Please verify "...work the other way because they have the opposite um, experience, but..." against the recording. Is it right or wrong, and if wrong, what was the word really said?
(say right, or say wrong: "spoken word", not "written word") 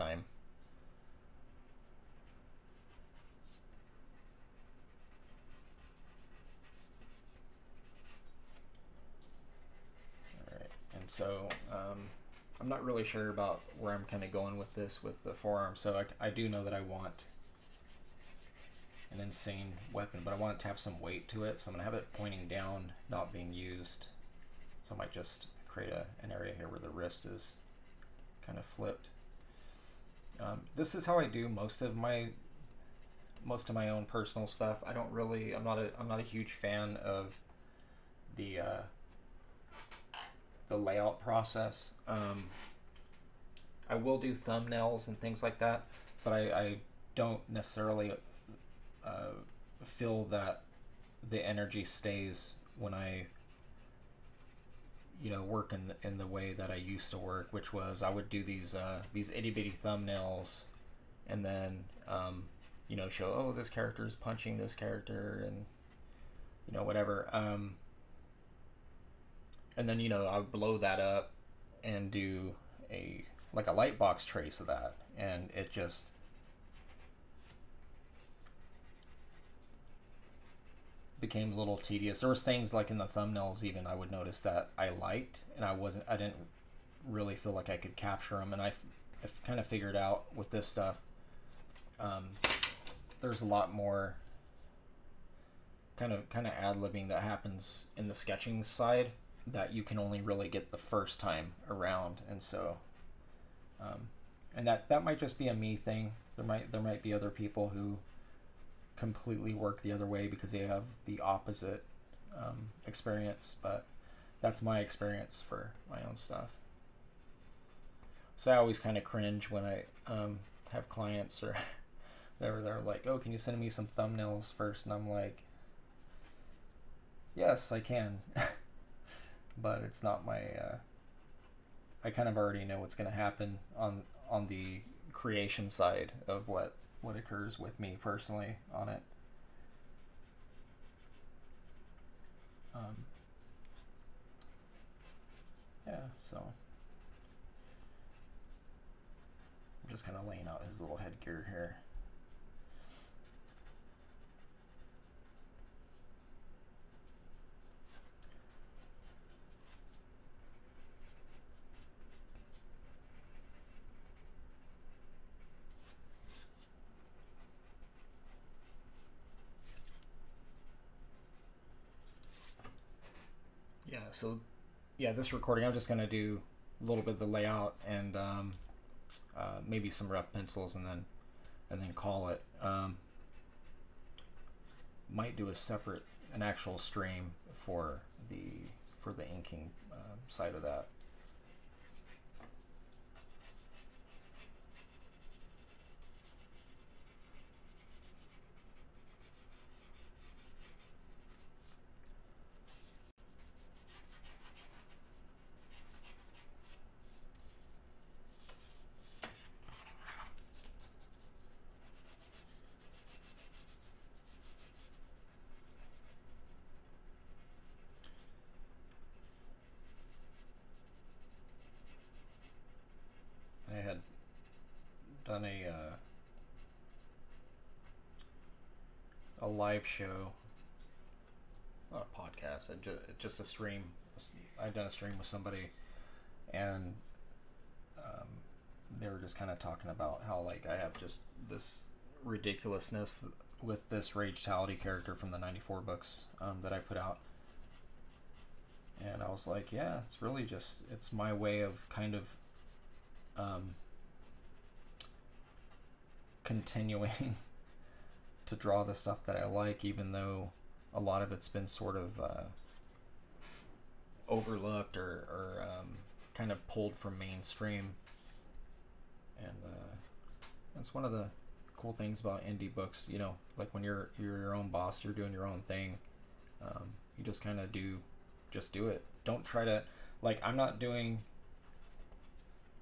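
right.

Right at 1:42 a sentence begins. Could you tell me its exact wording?
And so, um, and that, that might just be a me thing.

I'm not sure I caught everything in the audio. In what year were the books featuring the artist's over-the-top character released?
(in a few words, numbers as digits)
1994.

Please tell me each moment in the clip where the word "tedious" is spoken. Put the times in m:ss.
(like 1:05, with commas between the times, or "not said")
1:21.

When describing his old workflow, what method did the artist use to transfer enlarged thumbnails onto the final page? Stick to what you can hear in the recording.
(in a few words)
lightbox trace.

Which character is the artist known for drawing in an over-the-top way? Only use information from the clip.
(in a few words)
Ragetality.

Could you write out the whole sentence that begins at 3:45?
done a uh, a live show, not a podcast, just a stream.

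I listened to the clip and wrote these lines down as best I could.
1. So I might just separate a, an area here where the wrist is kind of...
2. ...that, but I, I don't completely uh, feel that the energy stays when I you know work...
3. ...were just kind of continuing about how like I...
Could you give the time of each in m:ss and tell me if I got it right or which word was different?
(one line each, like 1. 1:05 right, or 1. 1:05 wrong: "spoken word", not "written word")
1. 0:24 wrong: "create", not "separate"
2. 0:45 wrong: "necessarily", not "completely"
3. 3:59 wrong: "talking", not "continuing".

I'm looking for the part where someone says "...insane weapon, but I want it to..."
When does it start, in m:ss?
0:19.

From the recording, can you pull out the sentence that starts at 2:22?
Um, yeah, so I'm just kind of laying out his little headgear here.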